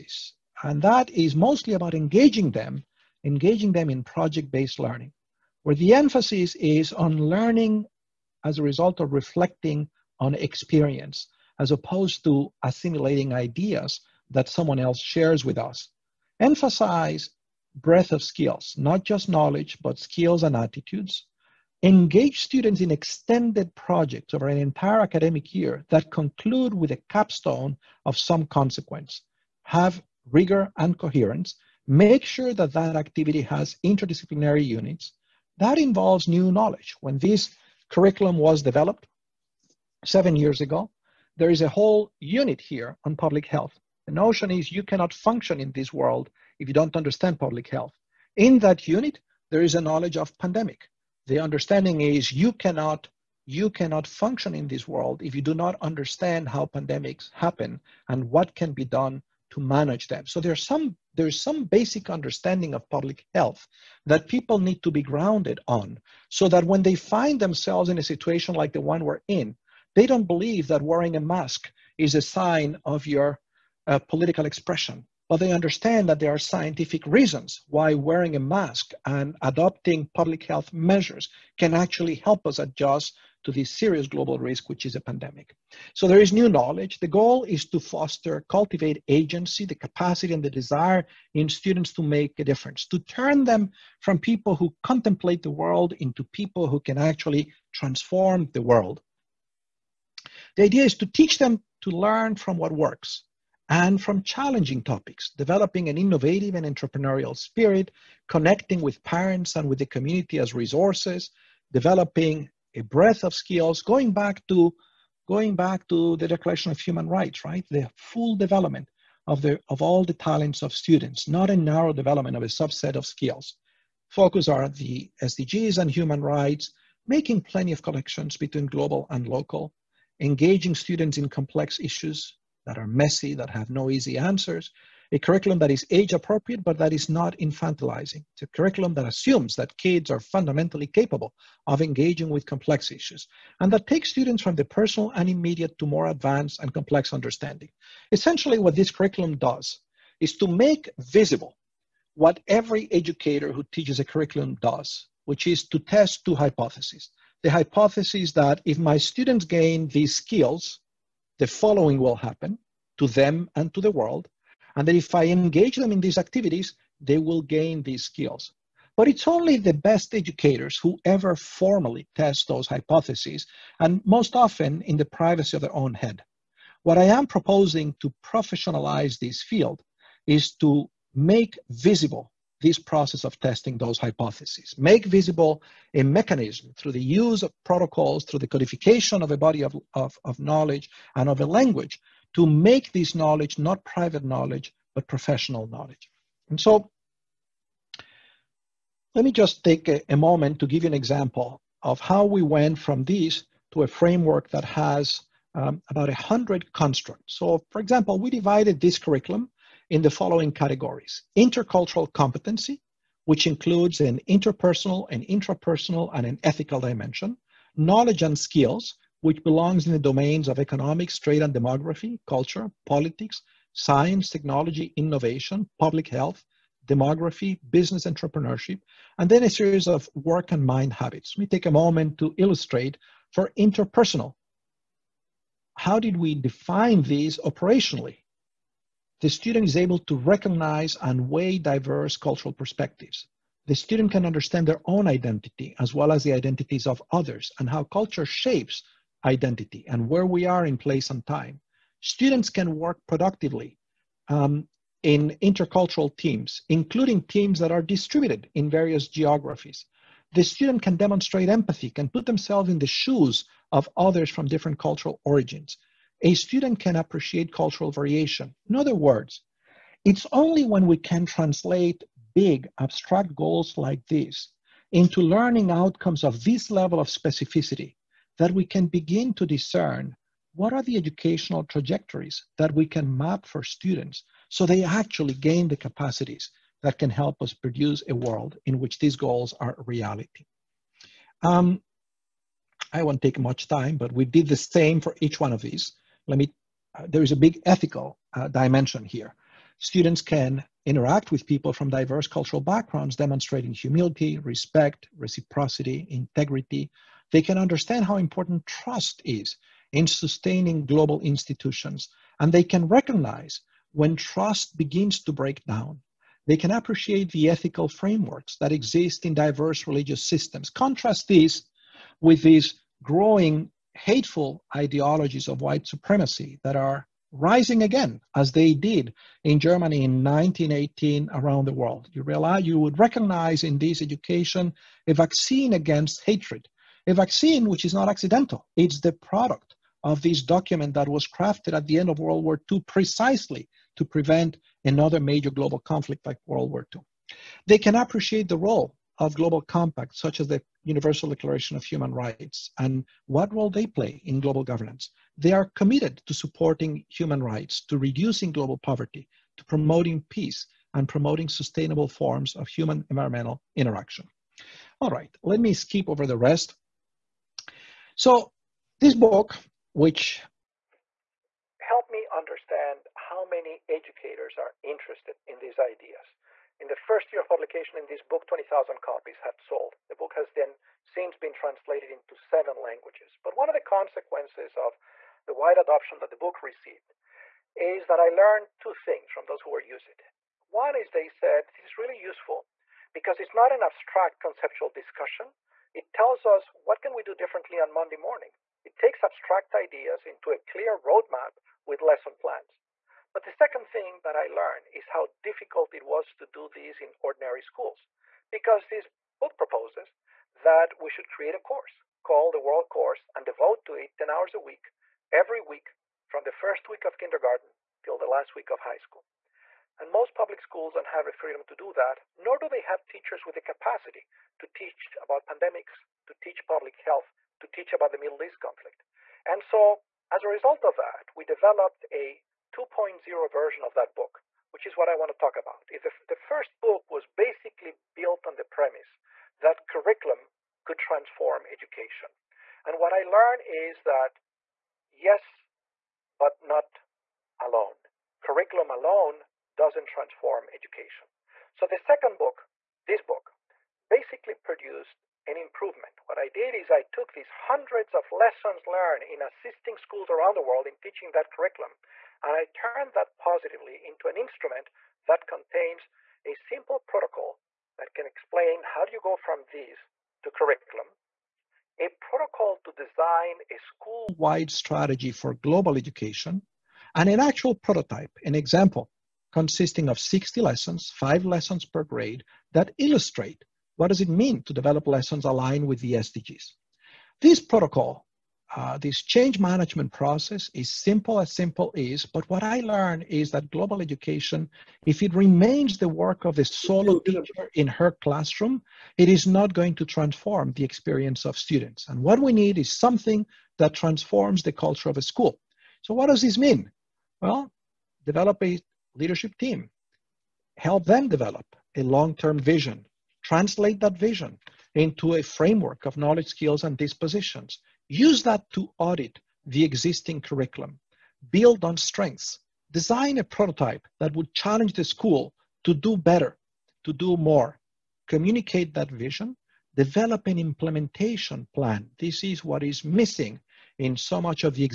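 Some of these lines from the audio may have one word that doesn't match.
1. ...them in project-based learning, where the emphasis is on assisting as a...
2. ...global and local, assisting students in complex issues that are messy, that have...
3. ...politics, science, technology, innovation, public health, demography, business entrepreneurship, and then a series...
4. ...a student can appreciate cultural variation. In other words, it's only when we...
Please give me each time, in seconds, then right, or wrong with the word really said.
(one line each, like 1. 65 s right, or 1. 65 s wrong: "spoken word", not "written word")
1. 3 s wrong: "learning", not "assisting"
2. 128 s wrong: "engaging", not "assisting"
3. 222 s right
4. 266 s right.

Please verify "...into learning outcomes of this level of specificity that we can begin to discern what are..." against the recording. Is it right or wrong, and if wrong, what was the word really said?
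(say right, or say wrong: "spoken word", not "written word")
right.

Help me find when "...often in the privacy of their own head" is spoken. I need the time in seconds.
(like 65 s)
174 s.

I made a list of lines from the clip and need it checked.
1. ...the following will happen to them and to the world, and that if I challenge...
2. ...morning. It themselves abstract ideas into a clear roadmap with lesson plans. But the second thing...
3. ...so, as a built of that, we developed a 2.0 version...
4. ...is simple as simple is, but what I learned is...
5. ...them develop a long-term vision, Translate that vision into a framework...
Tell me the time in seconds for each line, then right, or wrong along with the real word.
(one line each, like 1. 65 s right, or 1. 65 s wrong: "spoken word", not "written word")
1. 161 s wrong: "engage", not "challenge"
2. 398 s wrong: "takes", not "themselves"
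3. 429 s wrong: "result", not "built"
4. 490 s right
5. 511 s right.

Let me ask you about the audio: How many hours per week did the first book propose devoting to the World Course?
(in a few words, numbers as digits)
10.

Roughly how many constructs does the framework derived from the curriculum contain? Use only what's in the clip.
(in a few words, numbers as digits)
About 100.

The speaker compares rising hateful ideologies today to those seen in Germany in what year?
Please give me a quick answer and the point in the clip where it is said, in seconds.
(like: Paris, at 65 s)
1918, at 330 s.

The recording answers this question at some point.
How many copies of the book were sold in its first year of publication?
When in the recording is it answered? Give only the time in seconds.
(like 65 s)
378 s.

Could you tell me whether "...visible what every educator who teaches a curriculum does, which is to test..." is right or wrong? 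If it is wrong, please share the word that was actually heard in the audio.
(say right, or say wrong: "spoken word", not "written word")
right.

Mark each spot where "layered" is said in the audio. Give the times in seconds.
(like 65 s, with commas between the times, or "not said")
not said.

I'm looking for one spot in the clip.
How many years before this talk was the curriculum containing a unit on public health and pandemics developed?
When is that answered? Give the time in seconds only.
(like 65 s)
40 s.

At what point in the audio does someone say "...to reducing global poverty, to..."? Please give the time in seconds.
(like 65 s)
357 s.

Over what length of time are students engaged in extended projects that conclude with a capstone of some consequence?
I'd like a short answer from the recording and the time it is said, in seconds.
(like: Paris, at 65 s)
An entire academic year, at 24 s.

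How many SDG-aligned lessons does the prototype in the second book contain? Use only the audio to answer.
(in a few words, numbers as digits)
60.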